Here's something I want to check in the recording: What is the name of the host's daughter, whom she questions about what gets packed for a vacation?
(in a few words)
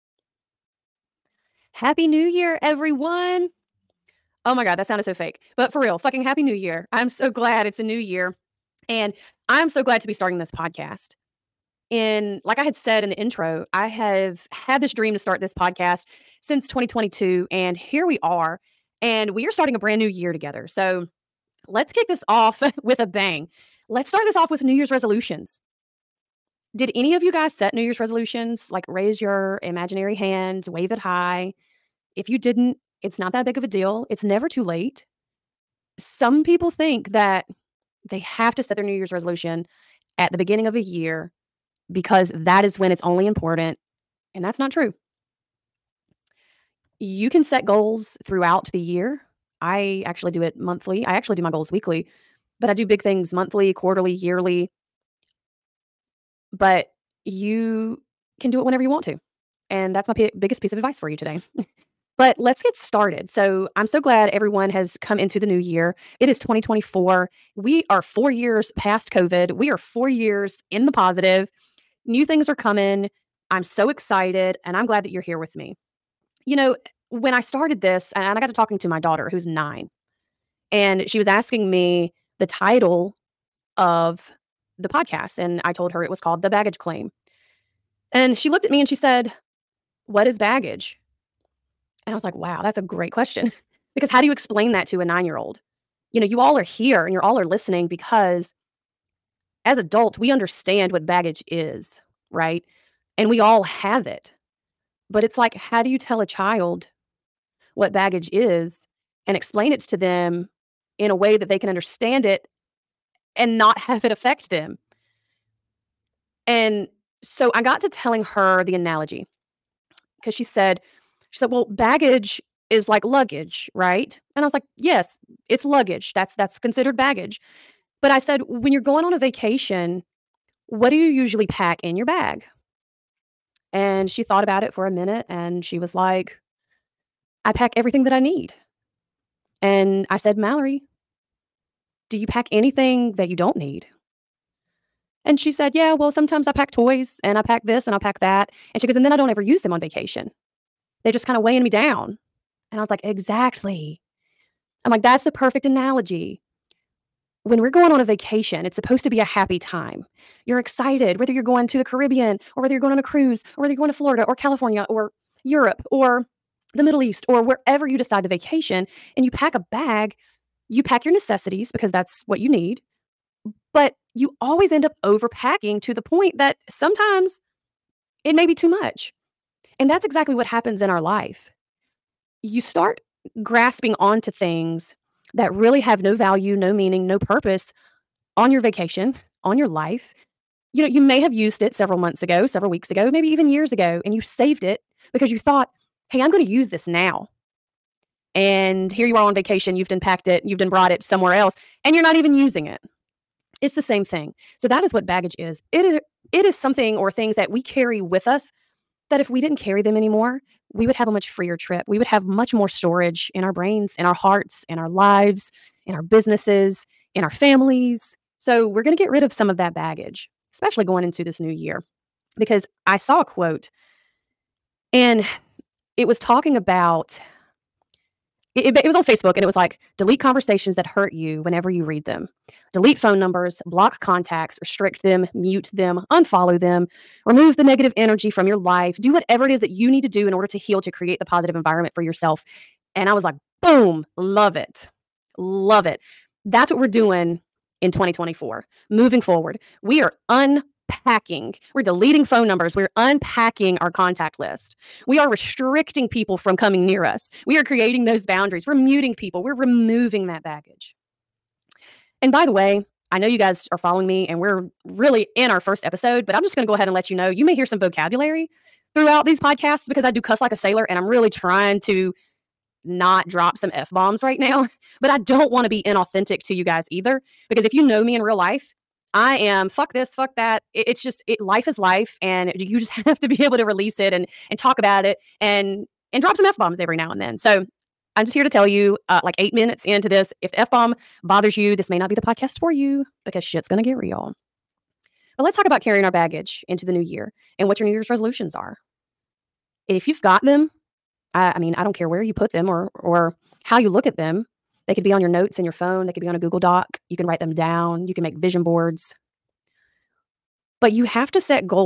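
Mallory.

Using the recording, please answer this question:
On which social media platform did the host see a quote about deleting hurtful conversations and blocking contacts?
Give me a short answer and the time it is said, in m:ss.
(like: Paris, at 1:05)
Facebook, at 3:49.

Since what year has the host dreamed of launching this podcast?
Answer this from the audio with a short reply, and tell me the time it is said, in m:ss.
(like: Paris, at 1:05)
2022, at 0:16.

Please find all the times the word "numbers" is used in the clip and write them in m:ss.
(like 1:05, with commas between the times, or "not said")
3:53, 4:12.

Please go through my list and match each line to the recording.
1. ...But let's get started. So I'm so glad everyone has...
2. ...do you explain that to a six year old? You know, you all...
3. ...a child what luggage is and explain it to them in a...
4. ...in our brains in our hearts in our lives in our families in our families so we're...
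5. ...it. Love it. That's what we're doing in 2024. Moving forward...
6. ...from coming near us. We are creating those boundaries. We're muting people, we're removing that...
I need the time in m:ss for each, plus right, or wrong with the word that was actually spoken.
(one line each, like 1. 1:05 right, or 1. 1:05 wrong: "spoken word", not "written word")
1. 1:02 right
2. 1:34 wrong: "nine", not "six"
3. 1:46 wrong: "baggage", not "luggage"
4. 3:33 wrong: "businesses", not "families"
5. 4:04 right
6. 4:16 right.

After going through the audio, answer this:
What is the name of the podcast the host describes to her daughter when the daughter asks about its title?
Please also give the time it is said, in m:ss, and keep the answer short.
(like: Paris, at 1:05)
The Baggage Claim, at 1:26.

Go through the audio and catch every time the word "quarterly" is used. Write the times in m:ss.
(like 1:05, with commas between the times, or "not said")
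0:53.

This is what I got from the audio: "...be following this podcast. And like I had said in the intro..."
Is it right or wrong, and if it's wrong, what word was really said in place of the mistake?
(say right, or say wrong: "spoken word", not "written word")
wrong: "starting", not "following".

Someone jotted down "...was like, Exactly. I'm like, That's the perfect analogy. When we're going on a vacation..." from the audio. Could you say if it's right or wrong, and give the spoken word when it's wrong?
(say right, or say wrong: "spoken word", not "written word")
right.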